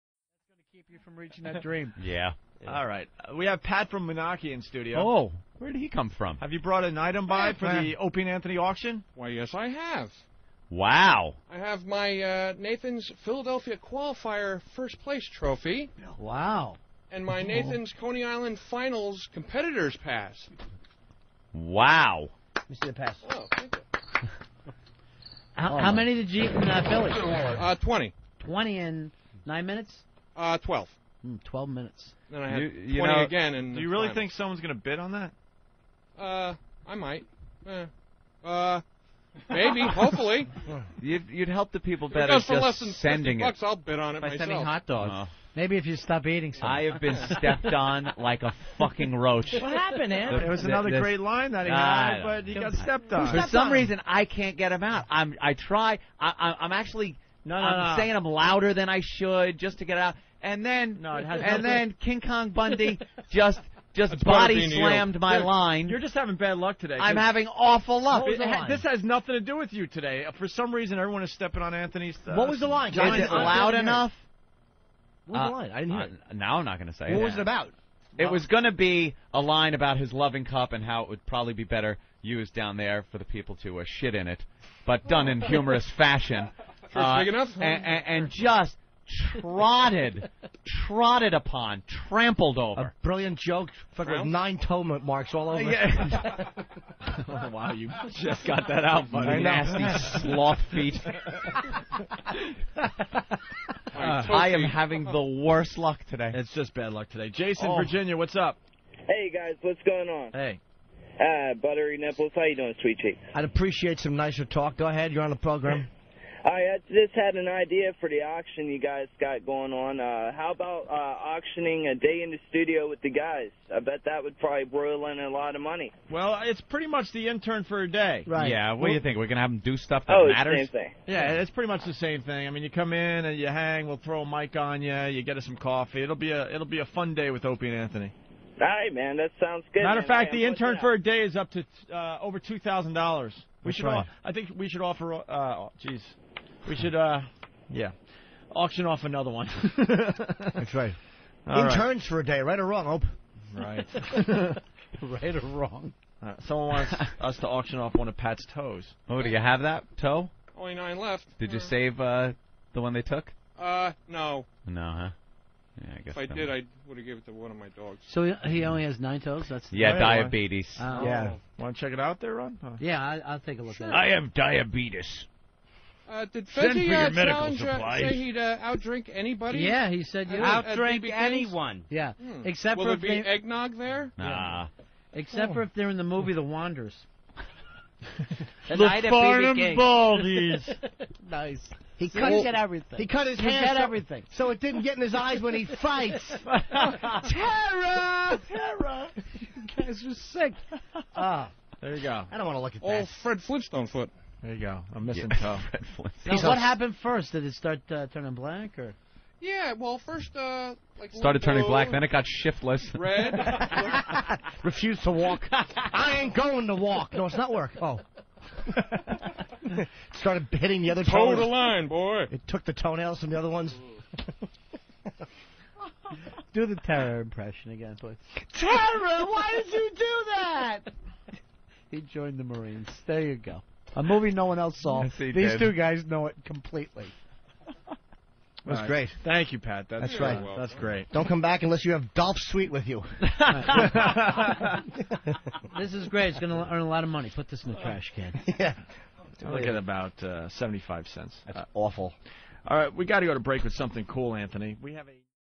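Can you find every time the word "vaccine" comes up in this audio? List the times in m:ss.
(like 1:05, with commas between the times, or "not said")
not said.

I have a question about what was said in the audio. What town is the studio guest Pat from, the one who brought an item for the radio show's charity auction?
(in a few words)
Moonachie.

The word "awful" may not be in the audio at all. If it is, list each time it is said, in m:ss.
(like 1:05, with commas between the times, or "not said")
1:07, 4:11.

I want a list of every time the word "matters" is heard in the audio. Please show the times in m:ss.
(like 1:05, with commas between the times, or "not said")
2:10, 2:19.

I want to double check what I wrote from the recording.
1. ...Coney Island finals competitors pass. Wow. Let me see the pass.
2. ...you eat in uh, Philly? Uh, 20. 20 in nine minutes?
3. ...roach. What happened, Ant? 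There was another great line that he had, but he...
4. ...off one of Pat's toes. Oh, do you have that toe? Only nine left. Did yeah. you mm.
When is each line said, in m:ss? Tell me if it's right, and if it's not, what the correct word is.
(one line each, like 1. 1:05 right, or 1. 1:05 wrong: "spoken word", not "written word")
1. 0:17 right
2. 0:26 right
3. 0:49 right
4. 2:37 right.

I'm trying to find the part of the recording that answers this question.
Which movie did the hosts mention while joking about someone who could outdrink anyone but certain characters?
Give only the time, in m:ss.
3:06.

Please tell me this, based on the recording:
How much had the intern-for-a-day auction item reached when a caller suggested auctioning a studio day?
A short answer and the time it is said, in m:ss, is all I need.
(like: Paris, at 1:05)
2000 dollars, at 2:22.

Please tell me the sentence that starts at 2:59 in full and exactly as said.
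Yeah, he said uh, you would outdrink anyone.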